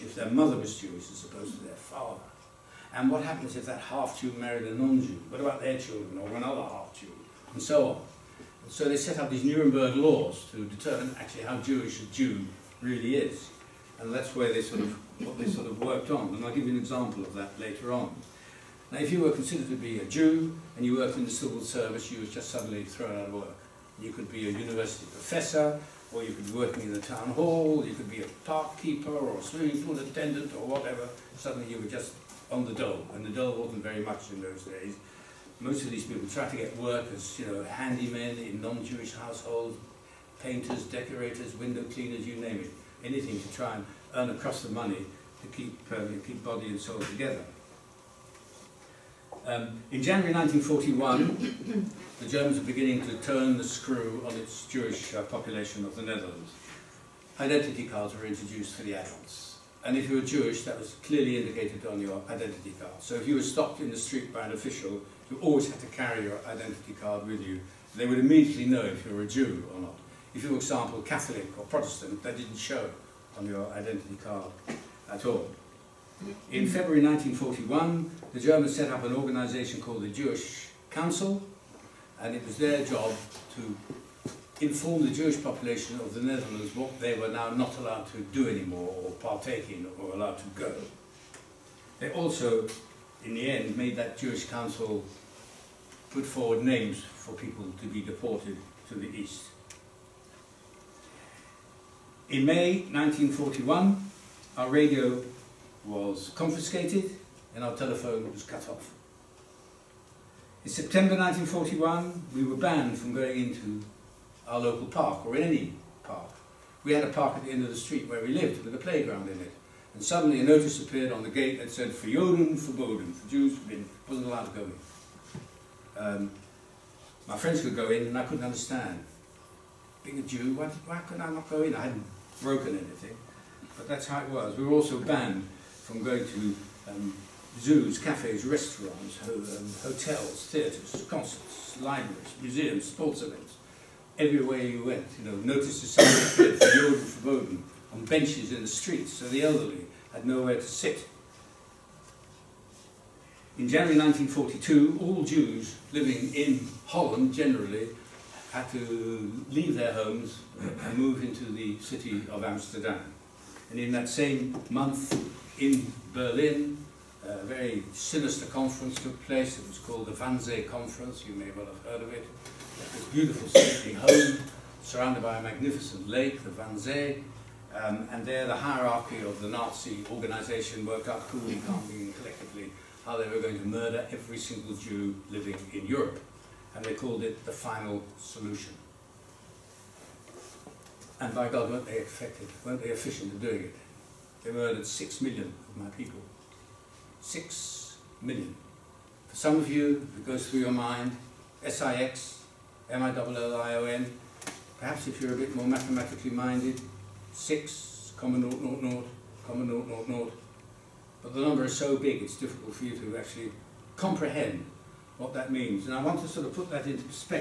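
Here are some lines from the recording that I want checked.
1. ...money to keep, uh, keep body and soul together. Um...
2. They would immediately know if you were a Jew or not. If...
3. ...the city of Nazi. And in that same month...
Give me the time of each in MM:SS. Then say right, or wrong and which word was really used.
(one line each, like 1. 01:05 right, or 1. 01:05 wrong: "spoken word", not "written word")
1. 00:44 right
2. 01:07 right
3. 02:41 wrong: "Amsterdam", not "Nazi".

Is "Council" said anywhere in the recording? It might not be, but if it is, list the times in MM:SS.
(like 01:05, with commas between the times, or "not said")
01:20, 01:34.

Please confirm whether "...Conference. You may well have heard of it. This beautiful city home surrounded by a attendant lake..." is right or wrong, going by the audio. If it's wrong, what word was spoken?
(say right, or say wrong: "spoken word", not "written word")
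wrong: "magnificent", not "attendant".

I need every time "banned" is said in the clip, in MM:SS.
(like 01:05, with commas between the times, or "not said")
01:52, 02:14.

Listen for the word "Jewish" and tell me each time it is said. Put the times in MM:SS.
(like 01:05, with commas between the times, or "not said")
00:00, 00:11, 00:38, 00:54, 01:00, 01:20, 01:25, 01:34.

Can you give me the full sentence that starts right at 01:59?
And suddenly a notice appeared on the gate that said, for Joden, verboden, for Jews, Wasn't allowed to go in.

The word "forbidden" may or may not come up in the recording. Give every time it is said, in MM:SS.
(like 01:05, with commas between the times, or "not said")
02:26.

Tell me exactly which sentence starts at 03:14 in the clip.
They murdered six million of my people.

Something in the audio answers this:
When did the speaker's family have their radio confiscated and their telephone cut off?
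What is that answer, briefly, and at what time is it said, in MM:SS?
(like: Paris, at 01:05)
May 1941, at 01:42.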